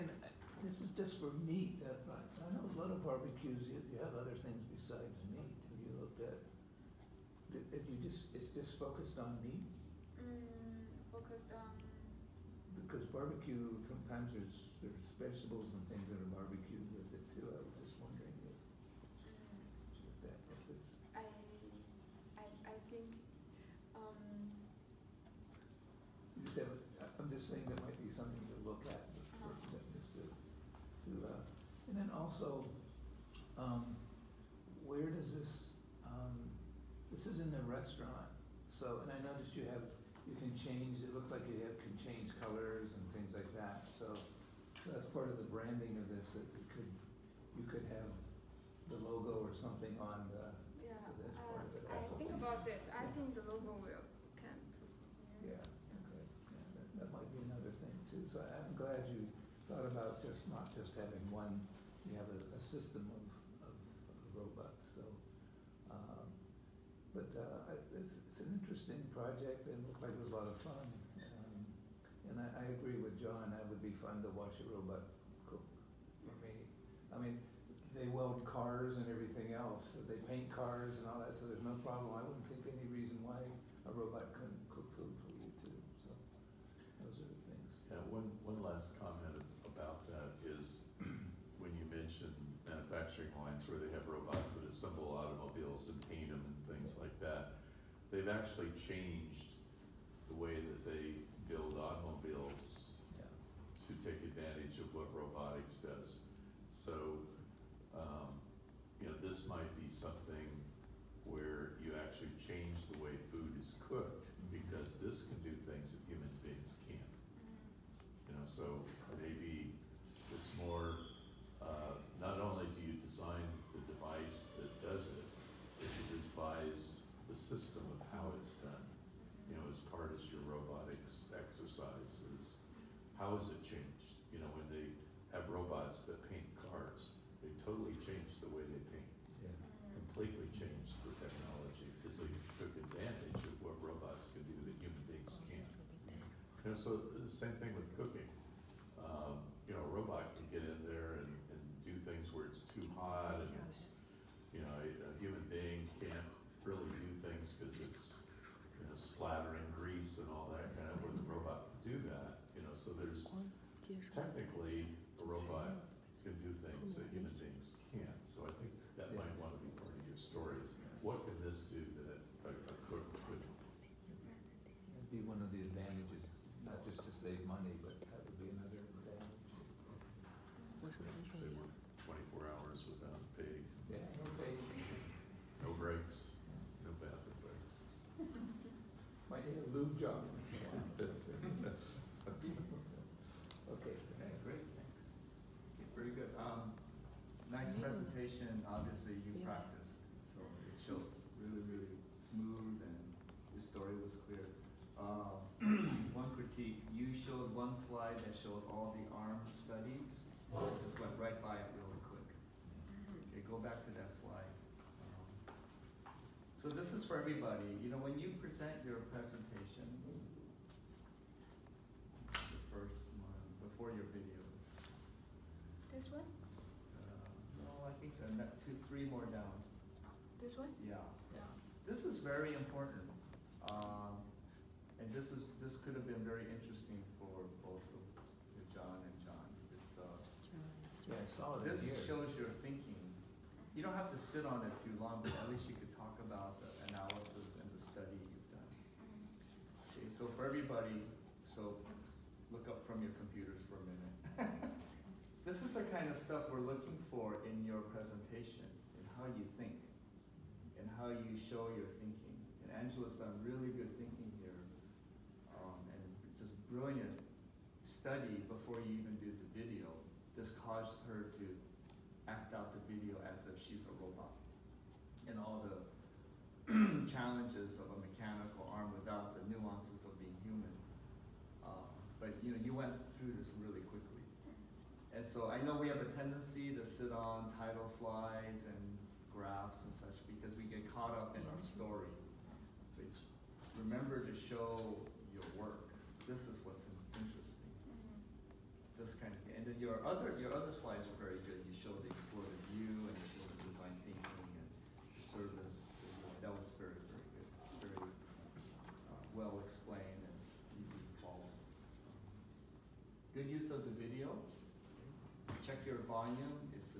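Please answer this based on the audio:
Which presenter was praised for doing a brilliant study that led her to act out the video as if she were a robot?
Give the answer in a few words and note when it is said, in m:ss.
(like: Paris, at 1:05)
Angela, at 4:22.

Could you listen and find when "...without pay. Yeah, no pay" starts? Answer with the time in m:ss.
3:02.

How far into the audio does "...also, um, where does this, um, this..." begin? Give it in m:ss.
0:32.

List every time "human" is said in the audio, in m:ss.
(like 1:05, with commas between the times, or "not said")
1:56, 2:24, 2:47, 4:40.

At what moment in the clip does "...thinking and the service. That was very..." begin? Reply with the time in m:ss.
5:04.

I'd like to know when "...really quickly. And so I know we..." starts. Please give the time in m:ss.
4:43.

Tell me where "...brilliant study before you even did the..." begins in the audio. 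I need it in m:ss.
4:26.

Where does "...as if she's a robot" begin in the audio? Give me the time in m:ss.
4:33.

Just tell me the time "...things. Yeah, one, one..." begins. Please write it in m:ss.
1:27.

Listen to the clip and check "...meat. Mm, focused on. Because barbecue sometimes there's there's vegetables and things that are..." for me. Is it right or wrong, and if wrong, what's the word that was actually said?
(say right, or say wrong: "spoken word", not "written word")
right.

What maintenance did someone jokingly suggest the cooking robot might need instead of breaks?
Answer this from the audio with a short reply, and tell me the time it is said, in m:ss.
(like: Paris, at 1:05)
A lube job, at 3:09.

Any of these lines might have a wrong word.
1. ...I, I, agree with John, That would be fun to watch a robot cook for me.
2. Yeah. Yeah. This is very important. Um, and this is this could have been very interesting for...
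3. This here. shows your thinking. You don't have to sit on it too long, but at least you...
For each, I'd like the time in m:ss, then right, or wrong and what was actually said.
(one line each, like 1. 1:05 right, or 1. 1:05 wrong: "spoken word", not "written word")
1. 1:12 right
2. 3:50 right
3. 4:01 right.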